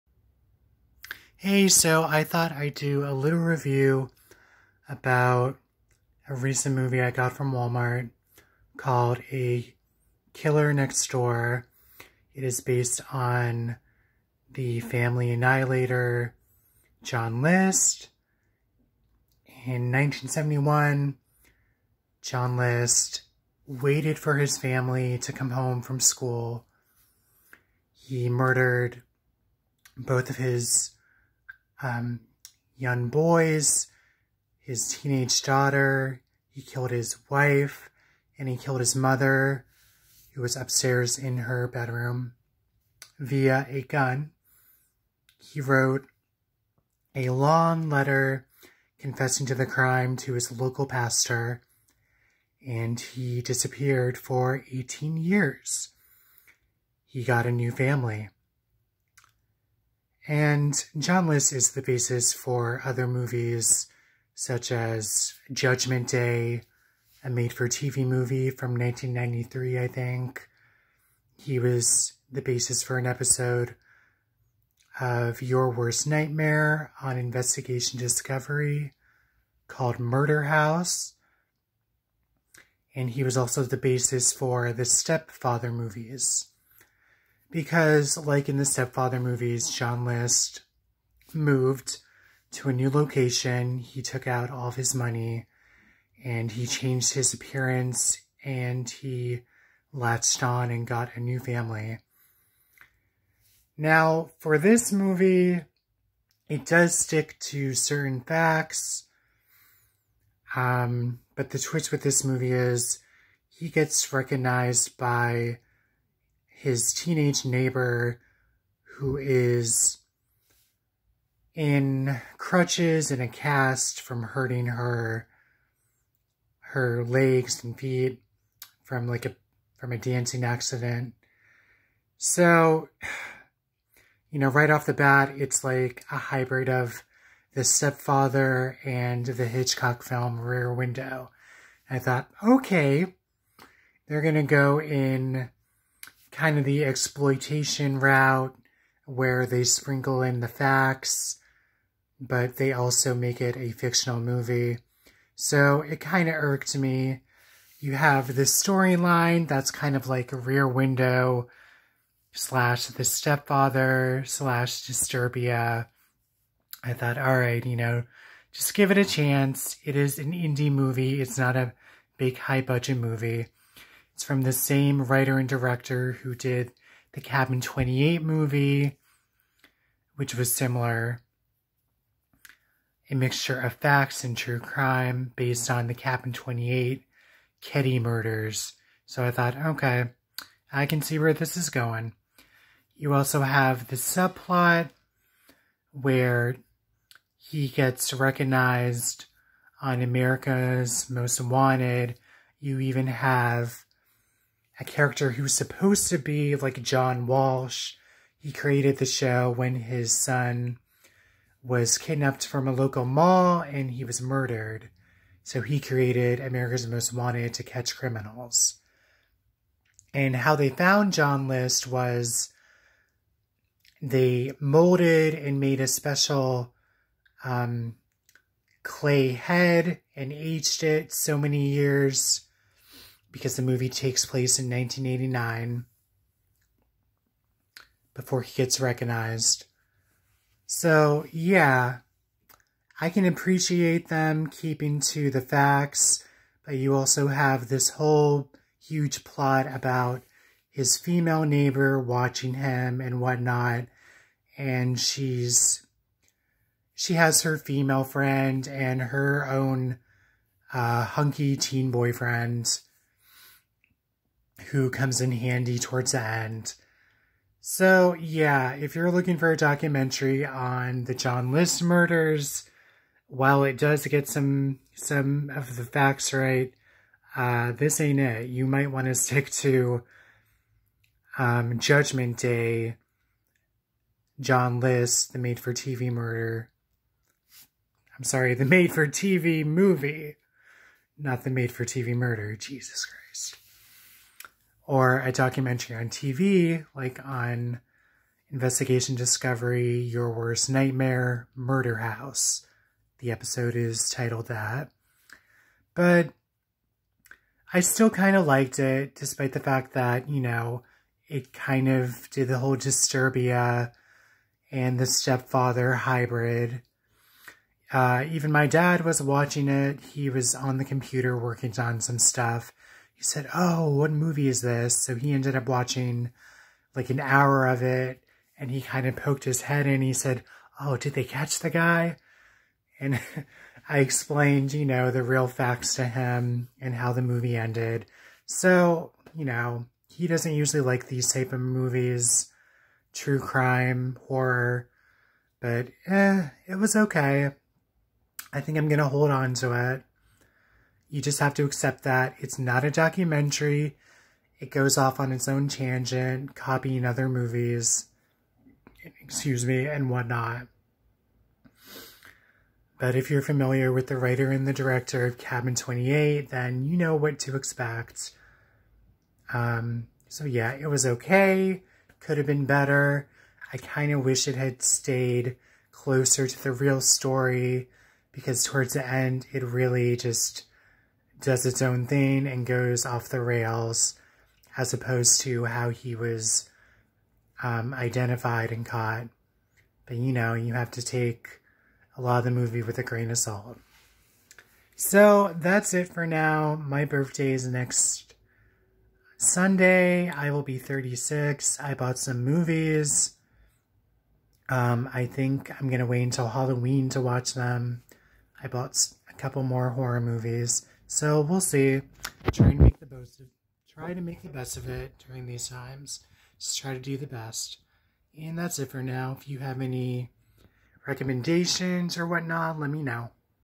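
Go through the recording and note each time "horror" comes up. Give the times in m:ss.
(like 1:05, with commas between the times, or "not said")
5:44, 6:49.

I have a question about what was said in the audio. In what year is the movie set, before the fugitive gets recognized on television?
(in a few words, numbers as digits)
1989.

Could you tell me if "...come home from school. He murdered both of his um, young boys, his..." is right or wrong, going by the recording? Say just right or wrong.
right.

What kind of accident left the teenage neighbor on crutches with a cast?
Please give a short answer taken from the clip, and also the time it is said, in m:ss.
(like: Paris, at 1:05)
A dancing accident, at 2:09.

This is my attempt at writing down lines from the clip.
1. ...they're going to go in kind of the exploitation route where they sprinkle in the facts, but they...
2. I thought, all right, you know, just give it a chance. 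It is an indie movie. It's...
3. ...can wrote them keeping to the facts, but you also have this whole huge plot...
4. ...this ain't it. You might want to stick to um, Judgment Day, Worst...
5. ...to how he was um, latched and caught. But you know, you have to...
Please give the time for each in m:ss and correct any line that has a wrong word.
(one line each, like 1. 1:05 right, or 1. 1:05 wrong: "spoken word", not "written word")
1. 2:24 right
2. 2:46 right
3. 4:03 wrong: "appreciate", not "wrote"
4. 4:37 wrong: "John", not "Worst"
5. 6:25 wrong: "identified", not "latched".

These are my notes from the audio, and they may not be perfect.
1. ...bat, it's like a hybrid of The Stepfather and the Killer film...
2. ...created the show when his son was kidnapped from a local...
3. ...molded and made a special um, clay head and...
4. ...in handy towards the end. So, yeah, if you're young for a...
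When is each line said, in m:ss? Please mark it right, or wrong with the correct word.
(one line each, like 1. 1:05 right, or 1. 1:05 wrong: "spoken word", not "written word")
1. 2:14 wrong: "Hitchcock", not "Killer"
2. 3:28 right
3. 3:44 right
4. 4:25 wrong: "looking", not "young".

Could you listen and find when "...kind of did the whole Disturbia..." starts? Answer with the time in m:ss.
5:11.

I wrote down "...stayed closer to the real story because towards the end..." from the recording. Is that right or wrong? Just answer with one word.
right.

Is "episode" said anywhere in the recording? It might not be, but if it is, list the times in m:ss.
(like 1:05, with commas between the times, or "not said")
1:13, 5:03.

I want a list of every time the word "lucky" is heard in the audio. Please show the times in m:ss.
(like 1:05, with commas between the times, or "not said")
not said.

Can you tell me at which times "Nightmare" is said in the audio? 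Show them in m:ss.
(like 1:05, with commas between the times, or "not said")
1:16, 5:00.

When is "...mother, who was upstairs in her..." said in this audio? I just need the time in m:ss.
0:38.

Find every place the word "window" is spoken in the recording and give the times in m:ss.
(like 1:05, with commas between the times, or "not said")
2:20, 2:40.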